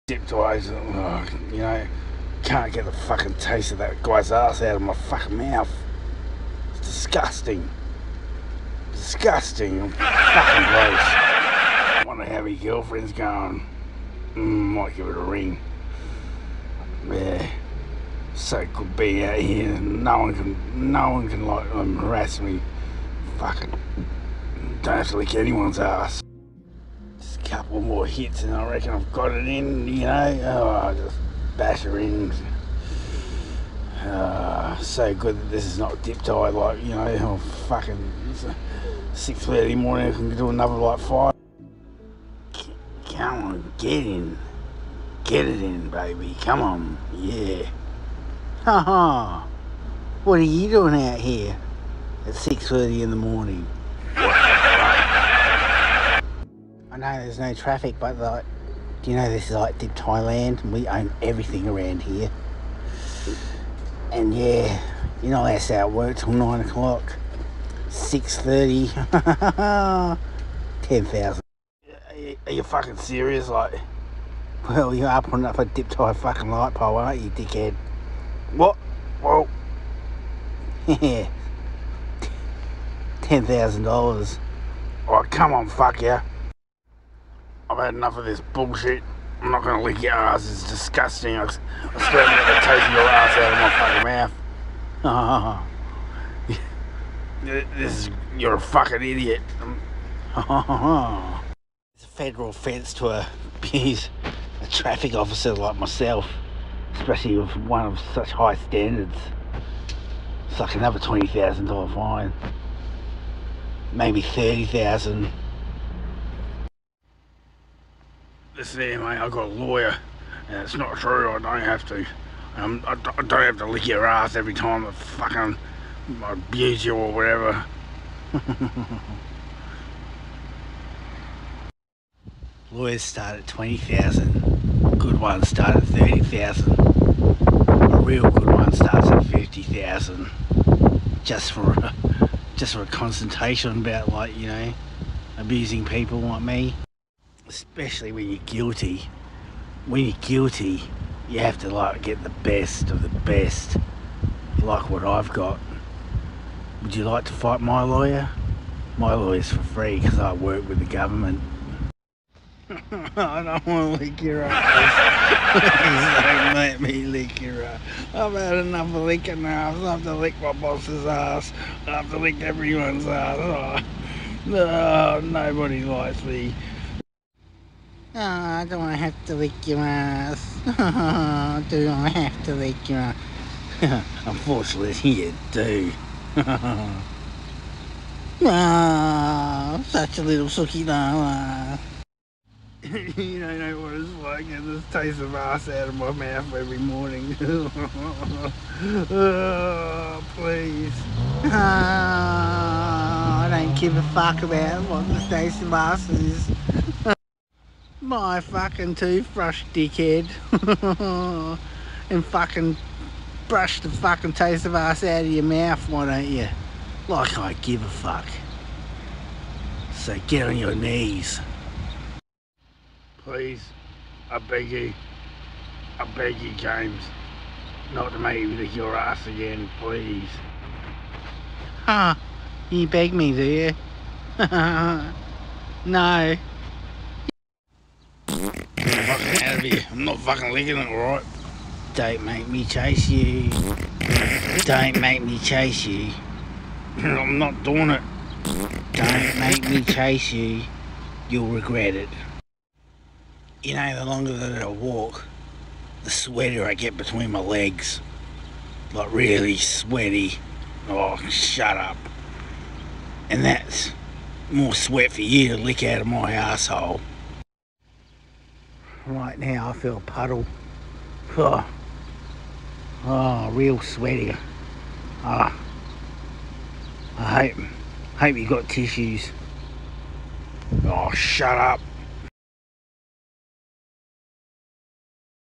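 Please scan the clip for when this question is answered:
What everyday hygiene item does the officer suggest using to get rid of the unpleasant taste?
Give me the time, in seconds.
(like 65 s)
208 s.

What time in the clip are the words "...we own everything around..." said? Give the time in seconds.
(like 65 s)
60 s.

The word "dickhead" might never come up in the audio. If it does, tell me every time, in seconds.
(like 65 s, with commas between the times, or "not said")
77 s, 209 s.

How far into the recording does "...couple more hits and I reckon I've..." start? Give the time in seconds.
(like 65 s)
27 s.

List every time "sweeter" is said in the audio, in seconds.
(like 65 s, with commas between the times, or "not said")
256 s.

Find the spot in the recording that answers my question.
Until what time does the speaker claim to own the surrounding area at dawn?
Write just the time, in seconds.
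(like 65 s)
66 s.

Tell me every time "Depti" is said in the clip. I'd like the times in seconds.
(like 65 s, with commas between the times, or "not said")
59 s, 75 s.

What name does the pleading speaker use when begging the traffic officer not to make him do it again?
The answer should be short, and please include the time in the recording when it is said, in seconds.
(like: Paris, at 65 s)
James, at 226 s.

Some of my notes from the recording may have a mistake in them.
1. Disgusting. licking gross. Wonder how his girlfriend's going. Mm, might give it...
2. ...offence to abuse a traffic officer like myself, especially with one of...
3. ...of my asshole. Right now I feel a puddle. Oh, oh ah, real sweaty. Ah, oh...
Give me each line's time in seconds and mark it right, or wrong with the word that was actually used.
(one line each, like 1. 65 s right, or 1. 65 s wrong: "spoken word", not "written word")
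1. 8 s wrong: "fucking", not "licking"
2. 102 s right
3. 266 s right.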